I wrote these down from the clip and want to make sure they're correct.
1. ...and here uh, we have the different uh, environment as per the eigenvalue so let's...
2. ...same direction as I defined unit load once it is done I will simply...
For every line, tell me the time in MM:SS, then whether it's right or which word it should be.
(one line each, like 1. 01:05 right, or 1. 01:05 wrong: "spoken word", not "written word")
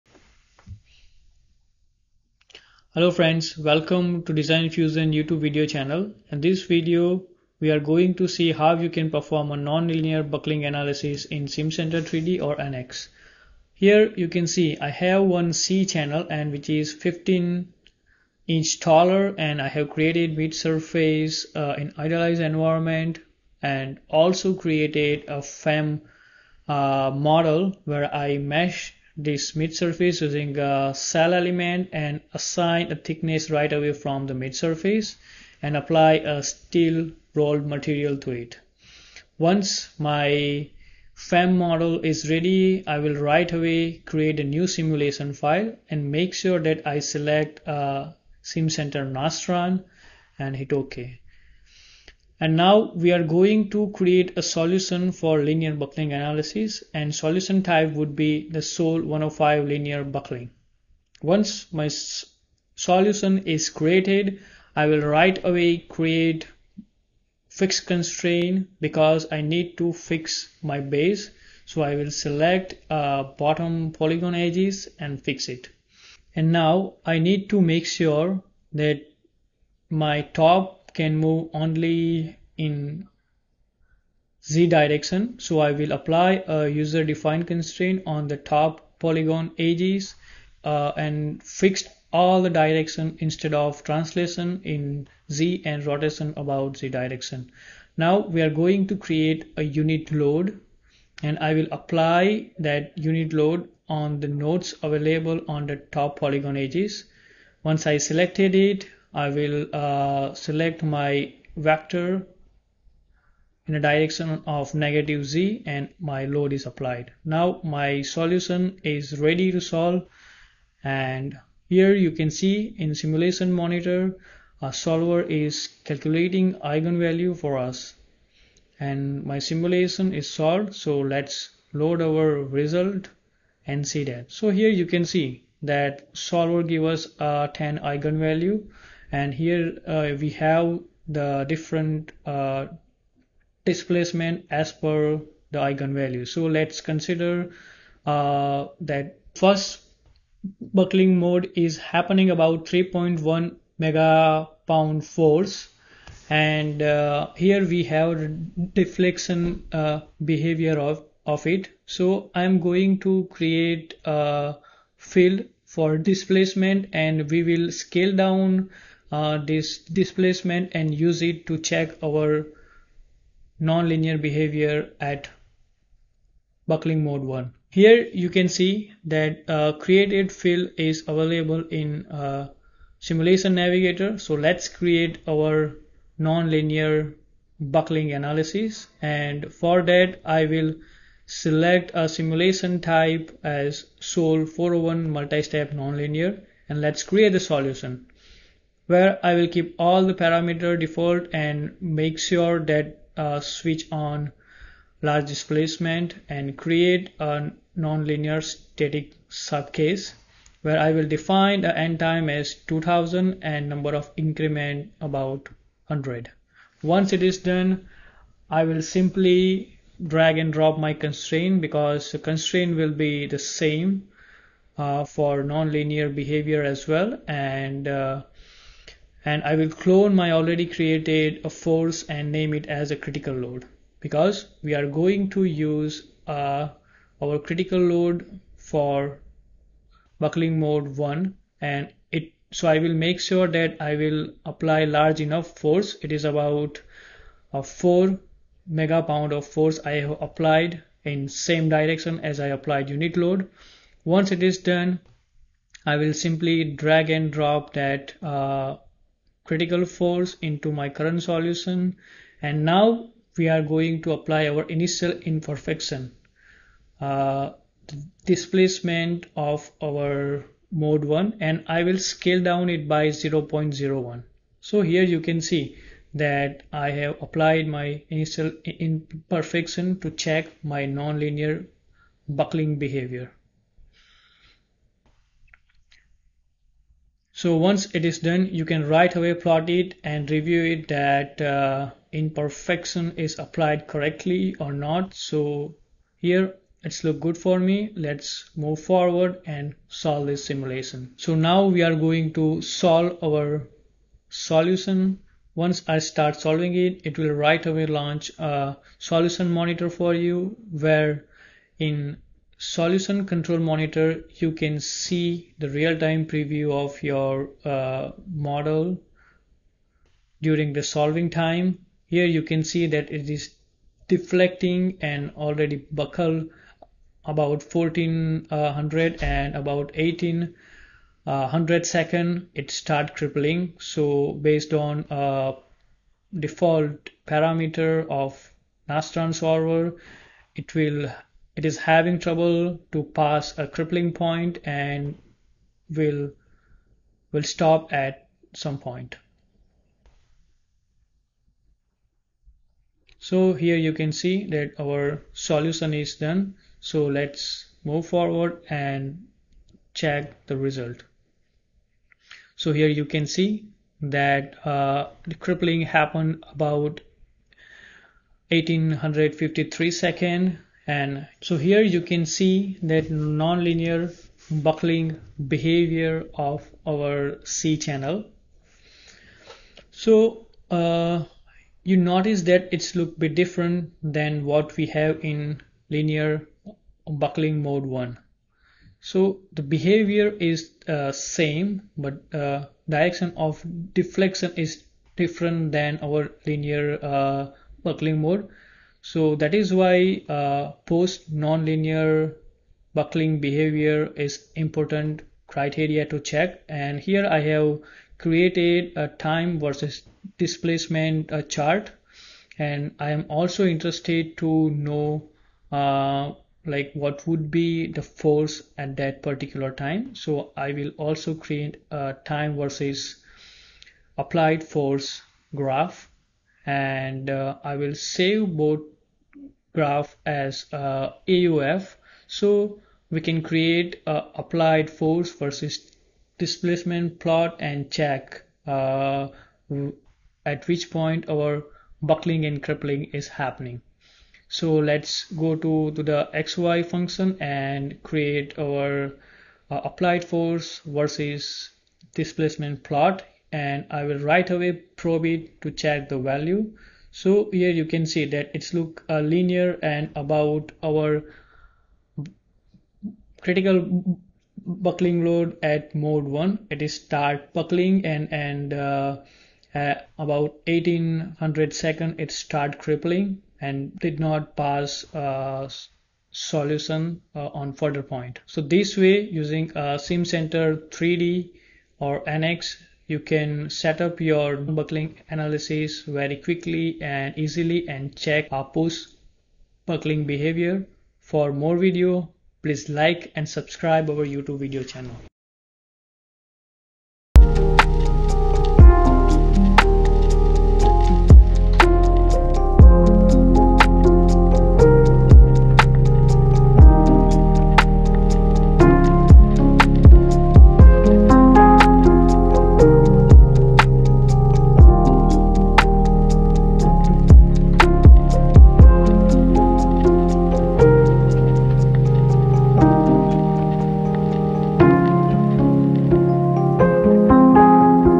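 1. 02:19 wrong: "displacement", not "environment"
2. 04:11 wrong: "applied", not "defined".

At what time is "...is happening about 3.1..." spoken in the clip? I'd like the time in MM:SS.
02:31.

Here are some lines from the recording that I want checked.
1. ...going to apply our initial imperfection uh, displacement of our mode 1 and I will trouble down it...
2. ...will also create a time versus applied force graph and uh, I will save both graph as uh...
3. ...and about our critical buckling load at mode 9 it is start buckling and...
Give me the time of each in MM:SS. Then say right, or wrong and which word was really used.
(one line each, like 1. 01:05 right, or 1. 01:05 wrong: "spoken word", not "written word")
1. 04:23 wrong: "scale", not "trouble"
2. 07:00 right
3. 07:39 wrong: "1", not "9".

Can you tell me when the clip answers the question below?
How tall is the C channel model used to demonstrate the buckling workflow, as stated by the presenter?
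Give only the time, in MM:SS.
00:16.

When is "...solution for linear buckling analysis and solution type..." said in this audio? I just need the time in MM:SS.
00:54.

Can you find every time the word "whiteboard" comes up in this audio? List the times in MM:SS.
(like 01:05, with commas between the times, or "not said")
not said.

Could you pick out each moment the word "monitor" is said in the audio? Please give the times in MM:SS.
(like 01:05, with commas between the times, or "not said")
02:03, 05:09, 05:13.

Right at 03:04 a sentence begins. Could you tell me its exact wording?
So let's create our nonlinear buckling analysis.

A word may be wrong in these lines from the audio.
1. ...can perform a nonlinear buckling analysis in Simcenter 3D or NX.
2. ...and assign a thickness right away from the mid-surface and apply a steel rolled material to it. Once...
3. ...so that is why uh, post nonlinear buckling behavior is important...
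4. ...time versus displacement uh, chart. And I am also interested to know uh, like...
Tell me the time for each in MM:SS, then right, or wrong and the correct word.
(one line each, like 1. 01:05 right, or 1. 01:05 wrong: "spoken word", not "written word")
1. 00:08 right
2. 00:31 right
3. 06:39 right
4. 06:49 right.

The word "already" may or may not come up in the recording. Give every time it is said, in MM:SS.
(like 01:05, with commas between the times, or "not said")
03:50, 05:25.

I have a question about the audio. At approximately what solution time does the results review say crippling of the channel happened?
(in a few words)
1853 seconds.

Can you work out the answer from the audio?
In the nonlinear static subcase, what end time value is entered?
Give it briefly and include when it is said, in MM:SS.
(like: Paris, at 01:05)
2000, at 03:32.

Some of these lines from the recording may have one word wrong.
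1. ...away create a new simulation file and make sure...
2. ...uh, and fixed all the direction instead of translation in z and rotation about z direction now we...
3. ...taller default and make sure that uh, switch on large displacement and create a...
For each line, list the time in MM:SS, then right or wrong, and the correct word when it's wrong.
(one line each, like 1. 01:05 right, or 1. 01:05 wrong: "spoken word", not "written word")
1. 00:43 right
2. 01:30 right
3. 03:20 wrong: "parameter", not "taller".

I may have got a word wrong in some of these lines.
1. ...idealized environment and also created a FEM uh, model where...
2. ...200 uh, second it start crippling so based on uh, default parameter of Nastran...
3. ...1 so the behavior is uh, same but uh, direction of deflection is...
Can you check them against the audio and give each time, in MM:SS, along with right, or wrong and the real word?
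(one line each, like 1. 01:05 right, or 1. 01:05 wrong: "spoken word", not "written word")
1. 00:21 right
2. 05:31 wrong: "100", not "200"
3. 06:27 right.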